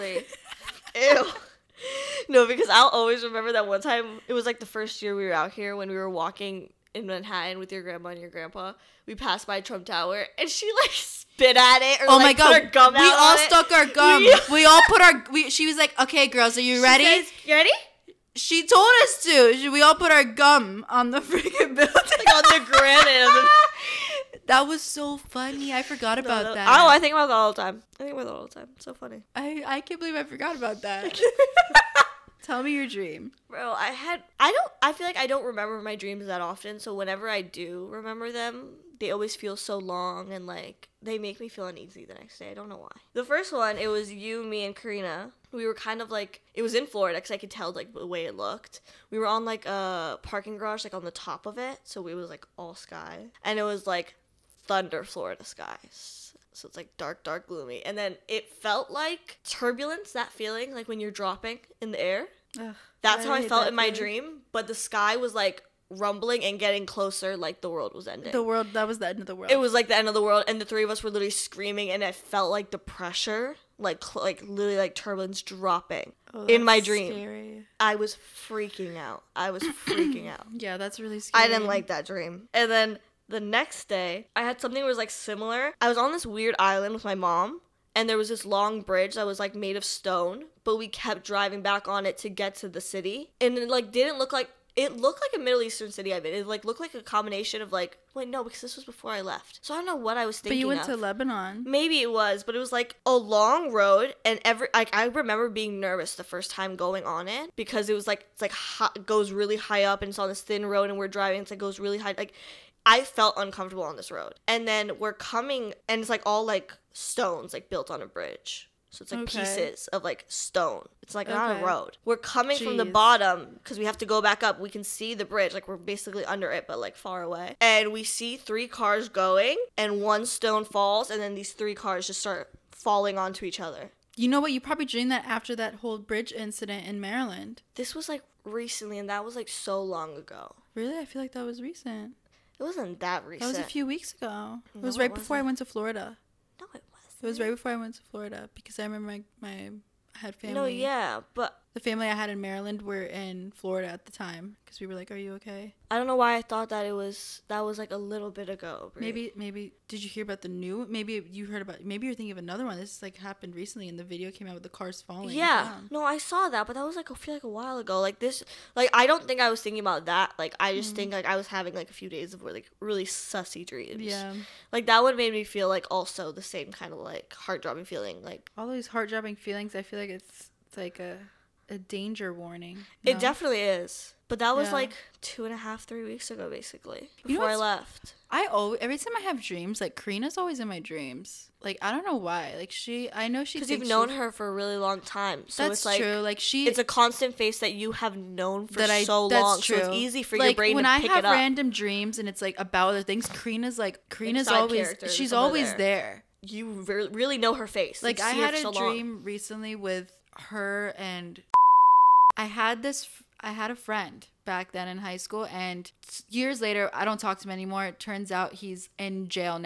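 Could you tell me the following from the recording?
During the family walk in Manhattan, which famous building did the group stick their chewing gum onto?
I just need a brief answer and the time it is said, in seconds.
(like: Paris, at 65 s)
Trump Tower, at 9 s.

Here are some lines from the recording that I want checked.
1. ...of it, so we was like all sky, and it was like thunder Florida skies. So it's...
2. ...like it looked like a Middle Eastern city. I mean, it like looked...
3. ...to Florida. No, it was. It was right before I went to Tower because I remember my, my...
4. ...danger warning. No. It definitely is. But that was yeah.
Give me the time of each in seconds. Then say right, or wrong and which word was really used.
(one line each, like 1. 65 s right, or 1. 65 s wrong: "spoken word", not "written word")
1. 51 s right
2. 94 s right
3. 145 s wrong: "Florida", not "Tower"
4. 181 s right.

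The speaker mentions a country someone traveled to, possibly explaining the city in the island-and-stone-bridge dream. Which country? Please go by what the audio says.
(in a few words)
Lebanon.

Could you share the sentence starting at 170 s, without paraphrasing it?
think like I was having like a few days of like really sussy dreams.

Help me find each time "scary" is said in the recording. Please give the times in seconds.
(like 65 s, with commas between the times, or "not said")
77 s, 81 s.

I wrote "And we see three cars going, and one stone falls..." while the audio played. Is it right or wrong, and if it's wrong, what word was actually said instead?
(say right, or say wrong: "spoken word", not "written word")
right.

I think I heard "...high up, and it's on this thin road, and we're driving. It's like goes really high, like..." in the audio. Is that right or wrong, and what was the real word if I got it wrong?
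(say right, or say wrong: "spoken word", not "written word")
right.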